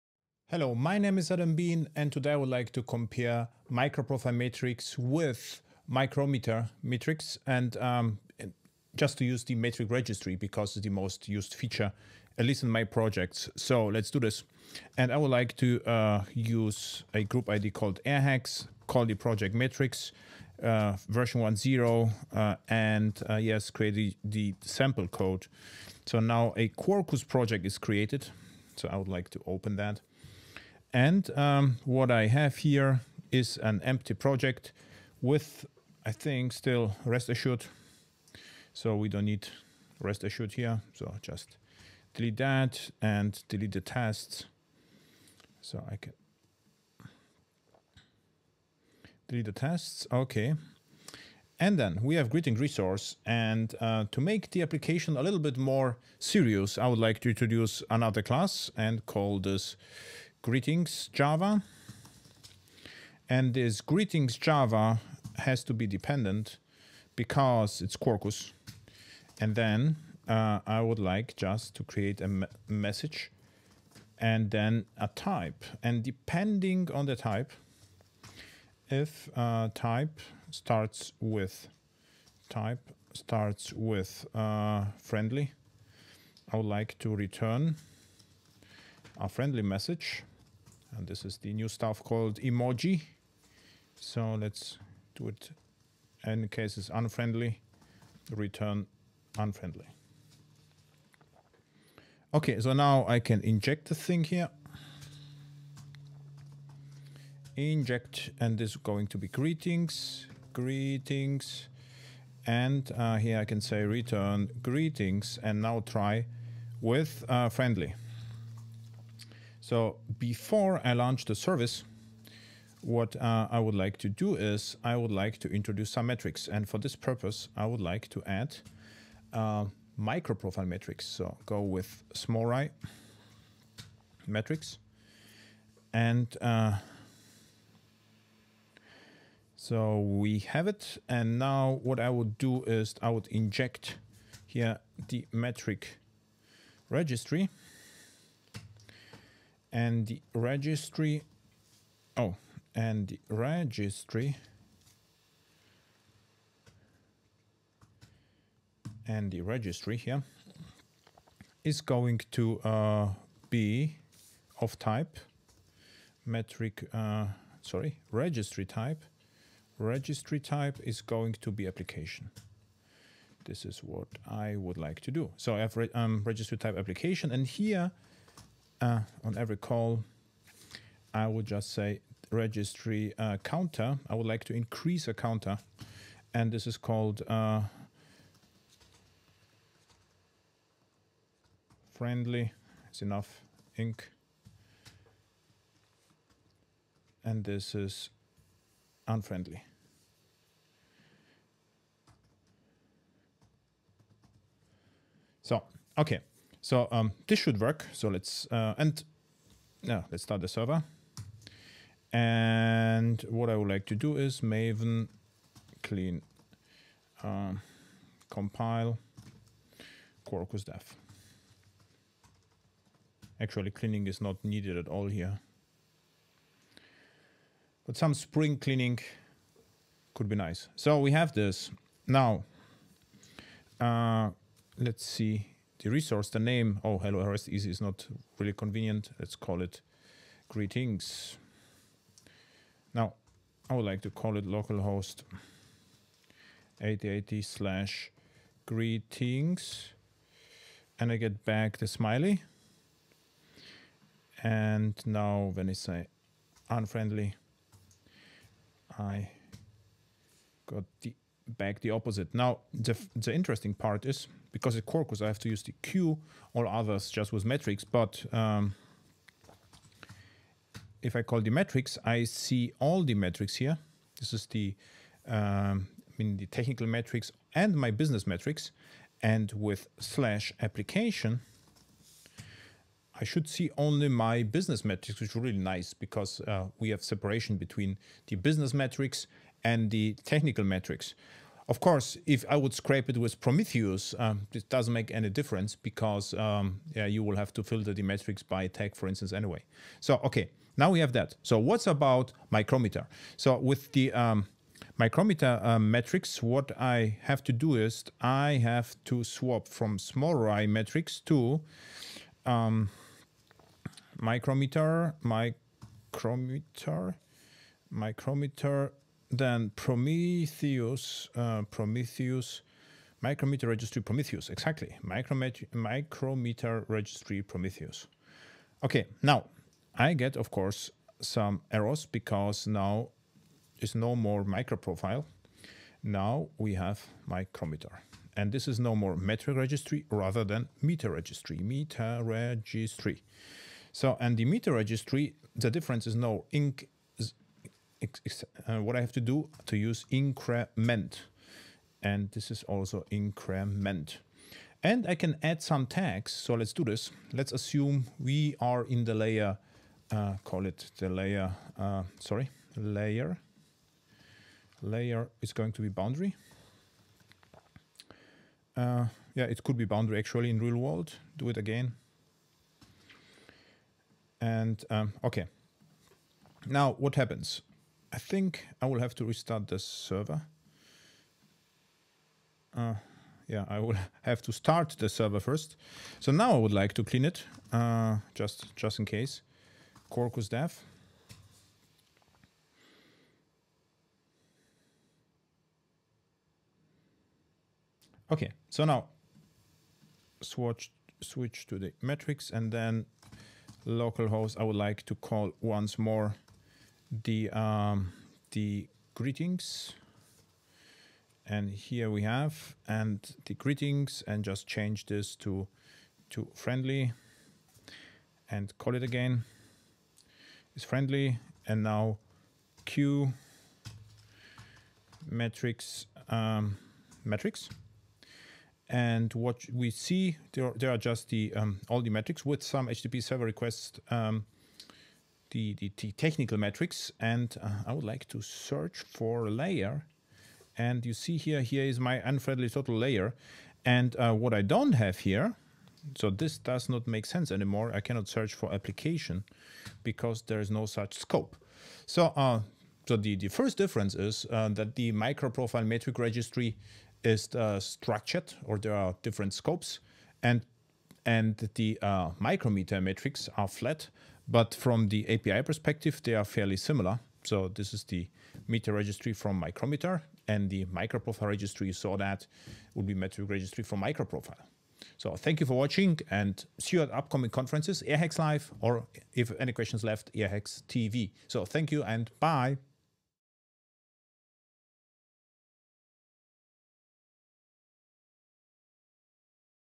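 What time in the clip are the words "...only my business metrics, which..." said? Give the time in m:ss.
4:43.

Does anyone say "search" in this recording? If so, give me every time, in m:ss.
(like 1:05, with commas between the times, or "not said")
7:18, 7:28.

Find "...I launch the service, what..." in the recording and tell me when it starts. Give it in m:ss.
2:00.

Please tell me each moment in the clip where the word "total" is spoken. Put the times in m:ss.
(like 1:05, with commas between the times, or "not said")
7:22.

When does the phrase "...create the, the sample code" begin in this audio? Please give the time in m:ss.
0:23.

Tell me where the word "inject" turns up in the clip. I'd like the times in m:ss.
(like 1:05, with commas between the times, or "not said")
1:43, 1:47, 2:23.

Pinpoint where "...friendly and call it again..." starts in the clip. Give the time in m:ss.
6:56.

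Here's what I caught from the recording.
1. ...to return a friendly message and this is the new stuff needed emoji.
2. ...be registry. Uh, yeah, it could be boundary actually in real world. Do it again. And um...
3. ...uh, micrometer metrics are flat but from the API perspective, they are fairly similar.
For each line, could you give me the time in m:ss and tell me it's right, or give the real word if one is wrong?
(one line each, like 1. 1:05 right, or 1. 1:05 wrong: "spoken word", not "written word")
1. 1:26 wrong: "called", not "needed"
2. 6:05 wrong: "boundary", not "registry"
3. 7:42 right.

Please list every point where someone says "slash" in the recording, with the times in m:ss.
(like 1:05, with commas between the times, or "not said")
4:07, 4:39.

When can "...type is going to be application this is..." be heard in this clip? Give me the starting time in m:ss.
2:50.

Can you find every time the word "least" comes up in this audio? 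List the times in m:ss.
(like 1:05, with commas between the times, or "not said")
0:12.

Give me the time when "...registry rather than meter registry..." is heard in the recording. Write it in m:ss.
5:39.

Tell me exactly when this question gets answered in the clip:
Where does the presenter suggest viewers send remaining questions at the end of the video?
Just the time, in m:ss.
8:00.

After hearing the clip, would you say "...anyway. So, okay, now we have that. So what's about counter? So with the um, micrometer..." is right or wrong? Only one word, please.
wrong.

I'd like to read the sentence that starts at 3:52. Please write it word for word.
Now, uh, let's see the resource, the name, oh, hello RESTEasy is not really convenient.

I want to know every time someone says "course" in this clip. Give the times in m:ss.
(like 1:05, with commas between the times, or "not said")
4:51, 5:30.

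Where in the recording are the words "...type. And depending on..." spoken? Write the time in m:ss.
1:15.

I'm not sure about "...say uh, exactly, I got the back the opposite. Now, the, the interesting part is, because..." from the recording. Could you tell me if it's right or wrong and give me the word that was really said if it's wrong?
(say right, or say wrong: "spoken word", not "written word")
wrong: "unfriendly", not "exactly".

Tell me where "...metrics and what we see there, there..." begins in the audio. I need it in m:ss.
7:07.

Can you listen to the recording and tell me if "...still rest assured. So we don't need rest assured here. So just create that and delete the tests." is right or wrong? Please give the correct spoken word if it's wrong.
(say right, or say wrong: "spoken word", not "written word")
wrong: "delete", not "create".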